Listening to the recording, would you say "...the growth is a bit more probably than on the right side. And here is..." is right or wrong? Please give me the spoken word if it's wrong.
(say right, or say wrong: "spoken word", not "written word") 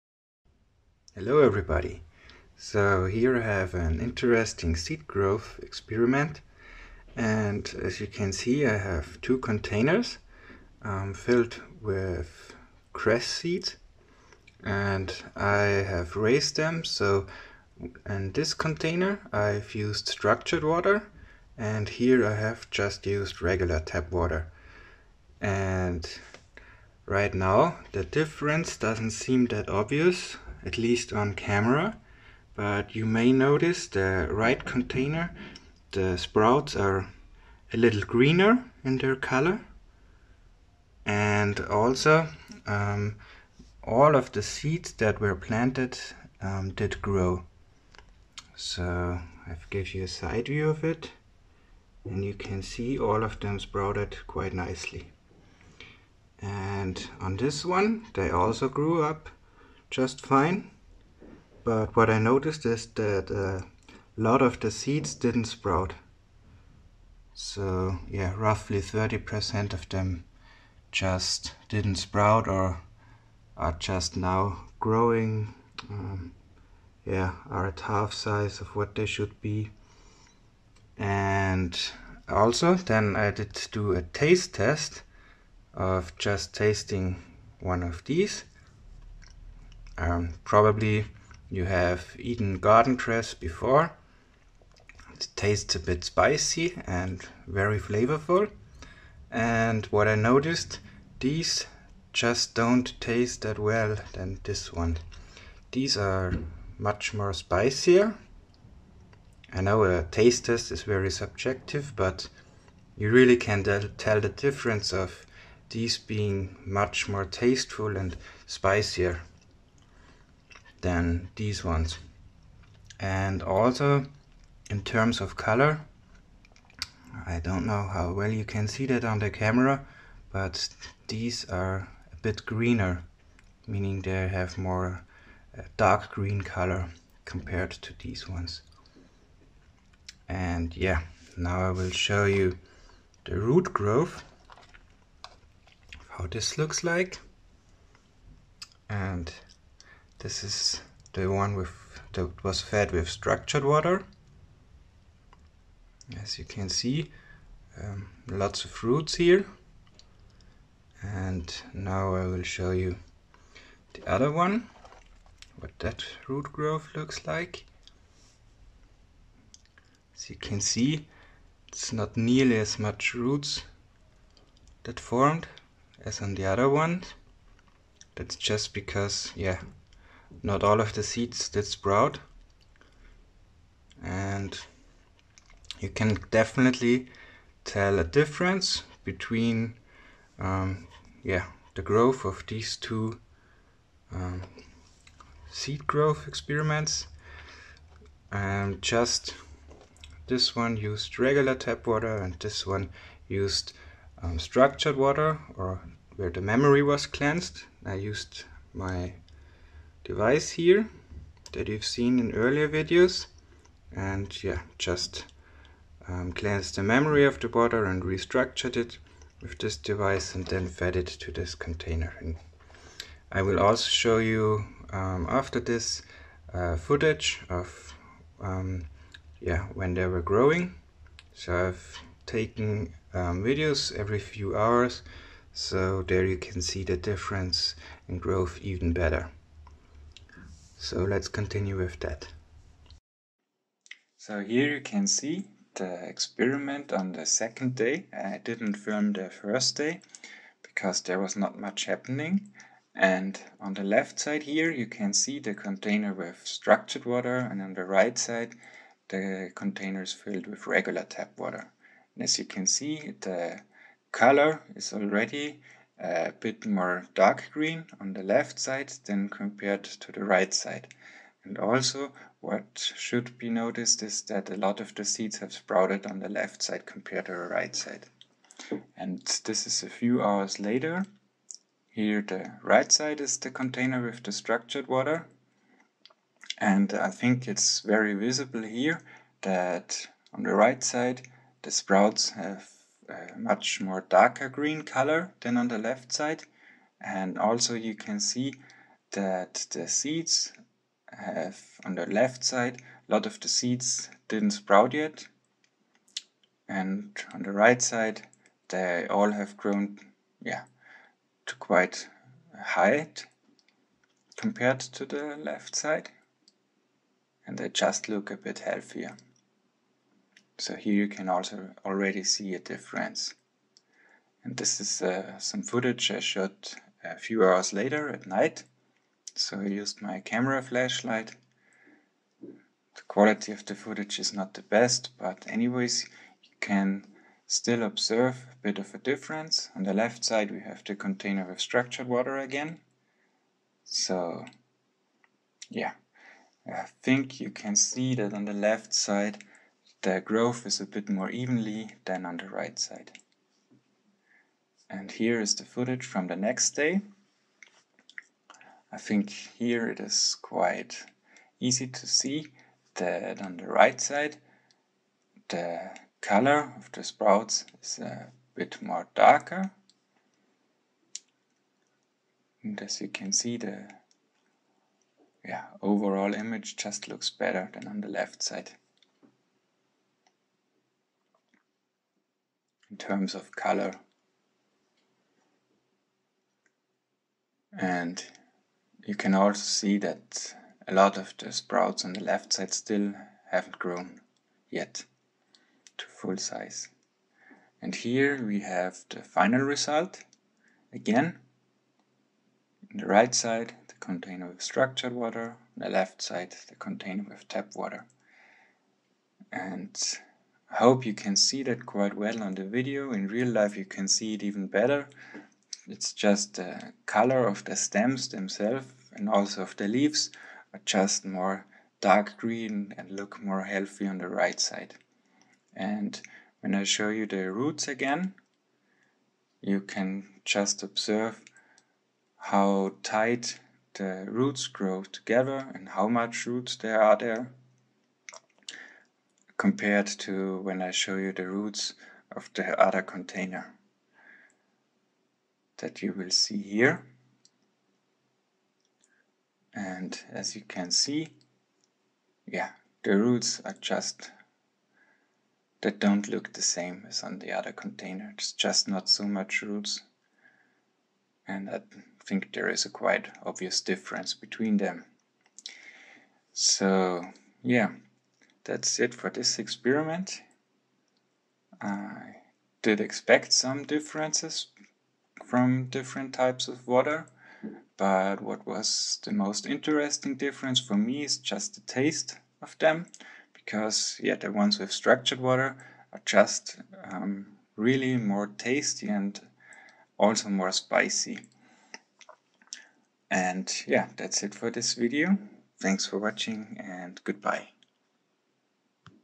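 wrong: "evenly", not "probably".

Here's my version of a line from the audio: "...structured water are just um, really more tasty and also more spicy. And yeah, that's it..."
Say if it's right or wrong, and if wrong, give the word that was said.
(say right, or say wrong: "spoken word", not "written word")
right.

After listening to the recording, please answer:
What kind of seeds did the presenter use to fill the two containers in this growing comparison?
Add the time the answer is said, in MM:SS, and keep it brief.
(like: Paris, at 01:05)
Cress seeds, at 00:12.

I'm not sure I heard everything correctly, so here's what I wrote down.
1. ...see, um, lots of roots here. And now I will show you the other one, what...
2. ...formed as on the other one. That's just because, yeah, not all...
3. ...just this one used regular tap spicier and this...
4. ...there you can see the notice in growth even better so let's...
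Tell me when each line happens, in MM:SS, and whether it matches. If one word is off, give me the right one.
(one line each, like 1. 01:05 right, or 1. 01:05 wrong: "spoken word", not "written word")
1. 02:36 right
2. 02:54 right
3. 03:18 wrong: "water", not "spicier"
4. 03:56 wrong: "difference", not "notice".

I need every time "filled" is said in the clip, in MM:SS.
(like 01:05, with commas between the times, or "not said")
00:11, 04:20.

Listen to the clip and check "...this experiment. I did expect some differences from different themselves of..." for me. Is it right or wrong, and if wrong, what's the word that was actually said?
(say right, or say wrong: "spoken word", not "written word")
wrong: "types", not "themselves".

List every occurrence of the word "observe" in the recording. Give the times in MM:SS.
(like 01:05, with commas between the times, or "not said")
05:37, 07:10.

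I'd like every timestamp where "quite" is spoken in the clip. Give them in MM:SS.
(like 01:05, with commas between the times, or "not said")
00:54, 05:11, 06:00, 06:51, 07:42.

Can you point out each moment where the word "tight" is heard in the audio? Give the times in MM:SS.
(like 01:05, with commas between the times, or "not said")
07:13.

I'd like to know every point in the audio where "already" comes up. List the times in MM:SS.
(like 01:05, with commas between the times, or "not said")
04:24, 05:21.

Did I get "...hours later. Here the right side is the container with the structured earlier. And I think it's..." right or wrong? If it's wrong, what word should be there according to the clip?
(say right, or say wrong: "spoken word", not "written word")
wrong: "water", not "earlier".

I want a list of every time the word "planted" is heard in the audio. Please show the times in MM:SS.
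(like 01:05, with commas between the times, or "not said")
00:45.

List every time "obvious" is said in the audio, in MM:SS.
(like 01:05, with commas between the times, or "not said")
00:29, 07:43.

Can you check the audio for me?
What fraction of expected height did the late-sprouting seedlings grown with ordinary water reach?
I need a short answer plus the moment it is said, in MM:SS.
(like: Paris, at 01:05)
Half size, at 01:17.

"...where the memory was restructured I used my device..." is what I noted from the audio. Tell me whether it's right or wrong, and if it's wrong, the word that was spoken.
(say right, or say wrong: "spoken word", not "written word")
wrong: "cleansed", not "restructured".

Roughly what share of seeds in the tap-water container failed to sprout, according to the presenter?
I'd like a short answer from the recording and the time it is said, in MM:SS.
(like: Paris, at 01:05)
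30%, at 01:08.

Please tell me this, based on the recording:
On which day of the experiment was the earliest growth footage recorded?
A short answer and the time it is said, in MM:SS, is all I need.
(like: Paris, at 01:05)
Second day, at 04:07.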